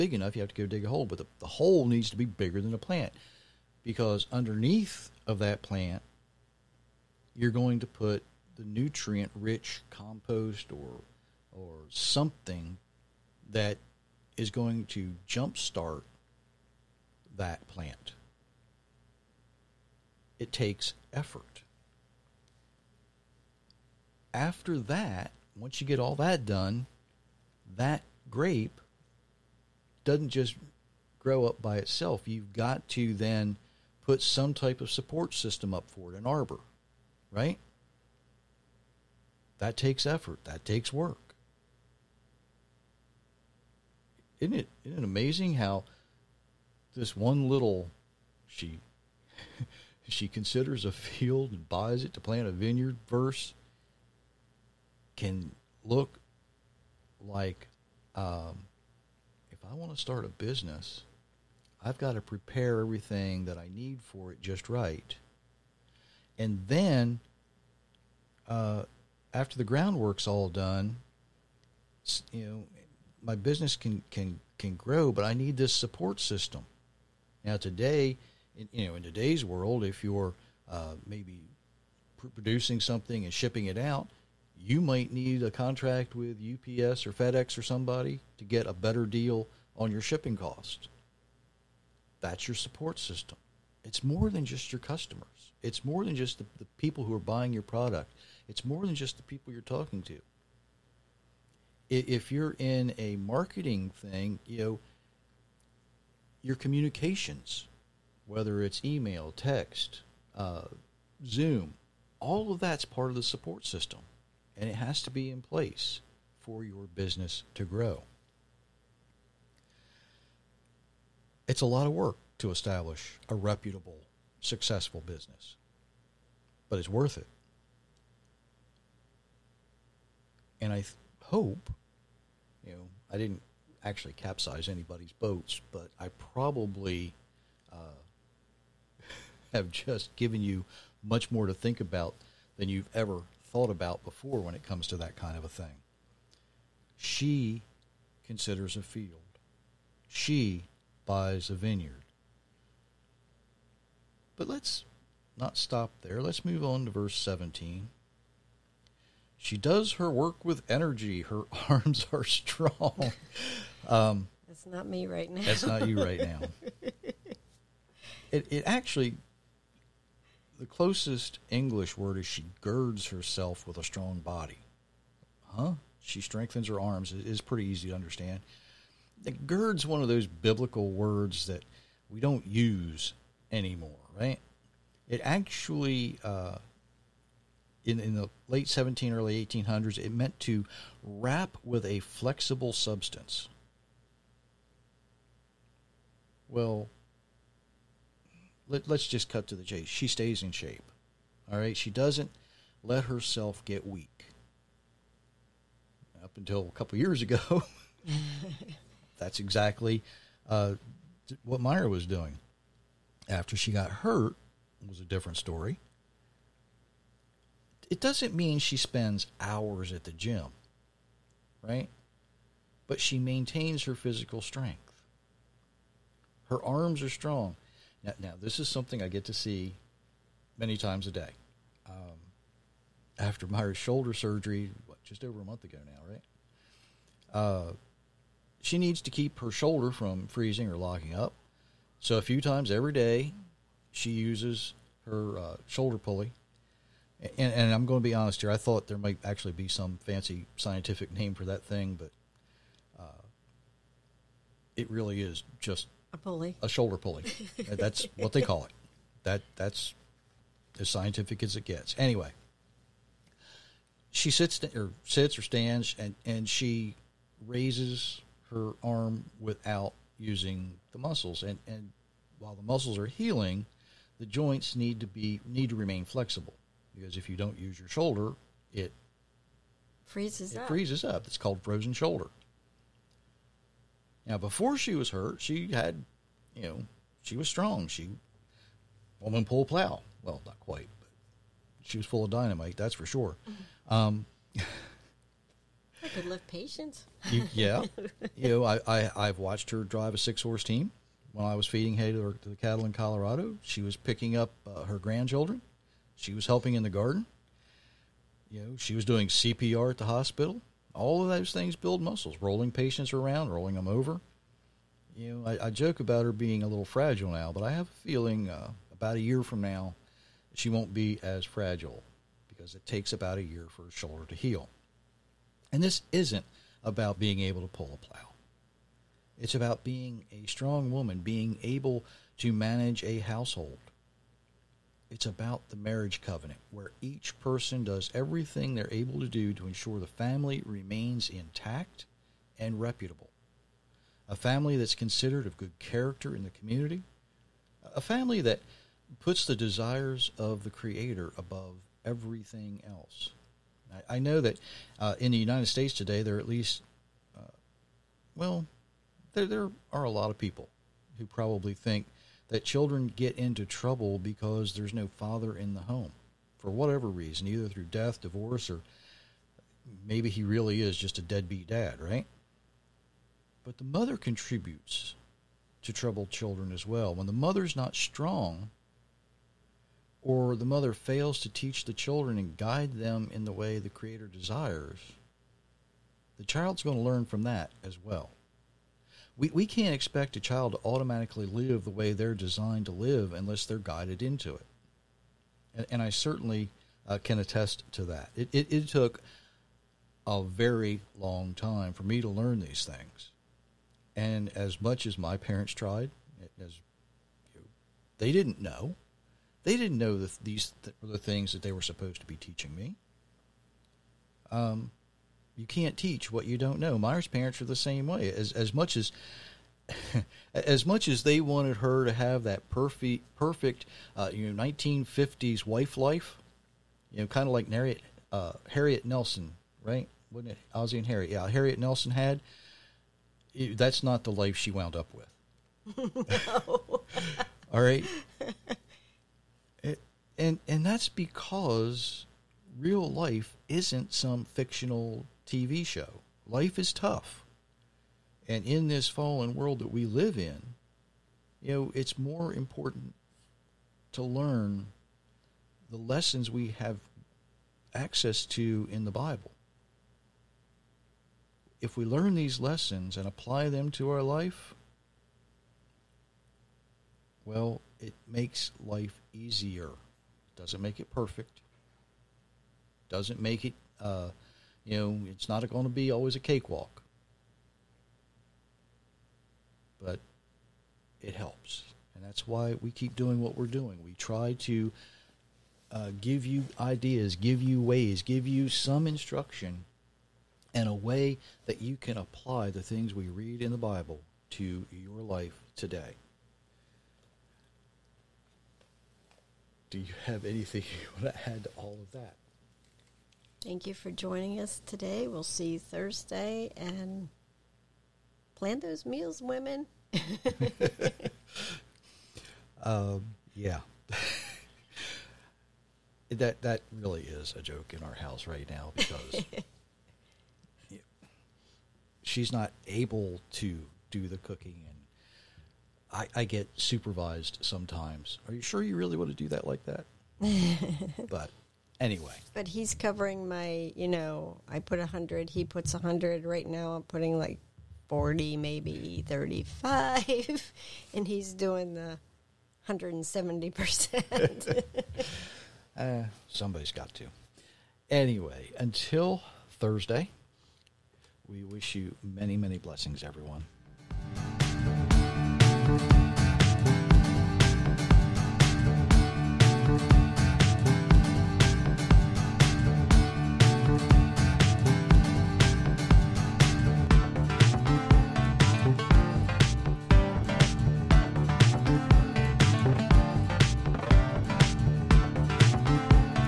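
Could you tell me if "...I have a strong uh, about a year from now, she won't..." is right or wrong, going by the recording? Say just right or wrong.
wrong.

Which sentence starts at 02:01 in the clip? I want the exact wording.
It's a lot of work to establish a reputable, successful business.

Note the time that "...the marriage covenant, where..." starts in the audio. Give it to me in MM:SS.
05:35.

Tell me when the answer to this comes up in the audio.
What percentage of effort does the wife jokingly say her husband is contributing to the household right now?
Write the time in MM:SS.
09:02.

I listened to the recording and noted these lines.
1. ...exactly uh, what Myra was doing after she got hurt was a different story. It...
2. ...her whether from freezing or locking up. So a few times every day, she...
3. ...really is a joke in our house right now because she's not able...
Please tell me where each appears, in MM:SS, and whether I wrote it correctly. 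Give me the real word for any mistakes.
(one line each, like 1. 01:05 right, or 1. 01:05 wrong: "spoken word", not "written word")
1. 03:29 right
2. 03:59 wrong: "shoulder", not "whether"
3. 08:37 right.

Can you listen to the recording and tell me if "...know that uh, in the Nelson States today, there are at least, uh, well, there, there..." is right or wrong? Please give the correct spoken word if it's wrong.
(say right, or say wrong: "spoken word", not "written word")
wrong: "United", not "Nelson".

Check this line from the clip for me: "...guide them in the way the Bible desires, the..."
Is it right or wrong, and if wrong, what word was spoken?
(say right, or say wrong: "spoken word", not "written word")
wrong: "Creator", not "Bible".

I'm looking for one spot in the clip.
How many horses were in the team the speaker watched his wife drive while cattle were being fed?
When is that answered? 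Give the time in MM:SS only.
05:00.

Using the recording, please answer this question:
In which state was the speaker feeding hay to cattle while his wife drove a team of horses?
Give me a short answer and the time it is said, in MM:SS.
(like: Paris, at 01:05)
Colorado, at 05:02.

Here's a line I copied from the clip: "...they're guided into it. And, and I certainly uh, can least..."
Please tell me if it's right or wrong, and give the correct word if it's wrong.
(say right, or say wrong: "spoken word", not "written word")
wrong: "attest", not "least".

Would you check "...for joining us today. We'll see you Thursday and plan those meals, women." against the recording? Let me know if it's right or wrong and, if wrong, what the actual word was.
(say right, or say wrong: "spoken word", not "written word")
right.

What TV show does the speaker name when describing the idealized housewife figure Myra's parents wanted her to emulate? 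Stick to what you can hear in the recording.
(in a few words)
Ozzie and Harriet.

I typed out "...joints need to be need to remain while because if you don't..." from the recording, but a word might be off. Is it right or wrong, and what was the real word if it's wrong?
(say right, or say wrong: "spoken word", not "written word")
wrong: "flexible", not "while".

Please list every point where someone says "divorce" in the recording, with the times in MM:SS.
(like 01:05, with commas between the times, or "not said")
06:08.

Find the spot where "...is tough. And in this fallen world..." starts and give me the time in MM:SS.
07:26.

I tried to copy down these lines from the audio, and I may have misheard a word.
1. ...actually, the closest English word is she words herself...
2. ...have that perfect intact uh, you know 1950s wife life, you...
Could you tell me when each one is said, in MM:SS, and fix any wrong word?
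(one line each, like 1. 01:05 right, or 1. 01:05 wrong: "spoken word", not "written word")
1. 02:48 wrong: "girds", not "words"
2. 07:02 wrong: "perfect", not "intact".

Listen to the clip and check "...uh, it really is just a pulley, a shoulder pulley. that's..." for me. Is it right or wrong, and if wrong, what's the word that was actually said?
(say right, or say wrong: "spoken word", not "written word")
right.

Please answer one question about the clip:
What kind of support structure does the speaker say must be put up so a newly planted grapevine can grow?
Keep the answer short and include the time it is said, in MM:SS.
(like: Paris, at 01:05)
An arbor, at 00:36.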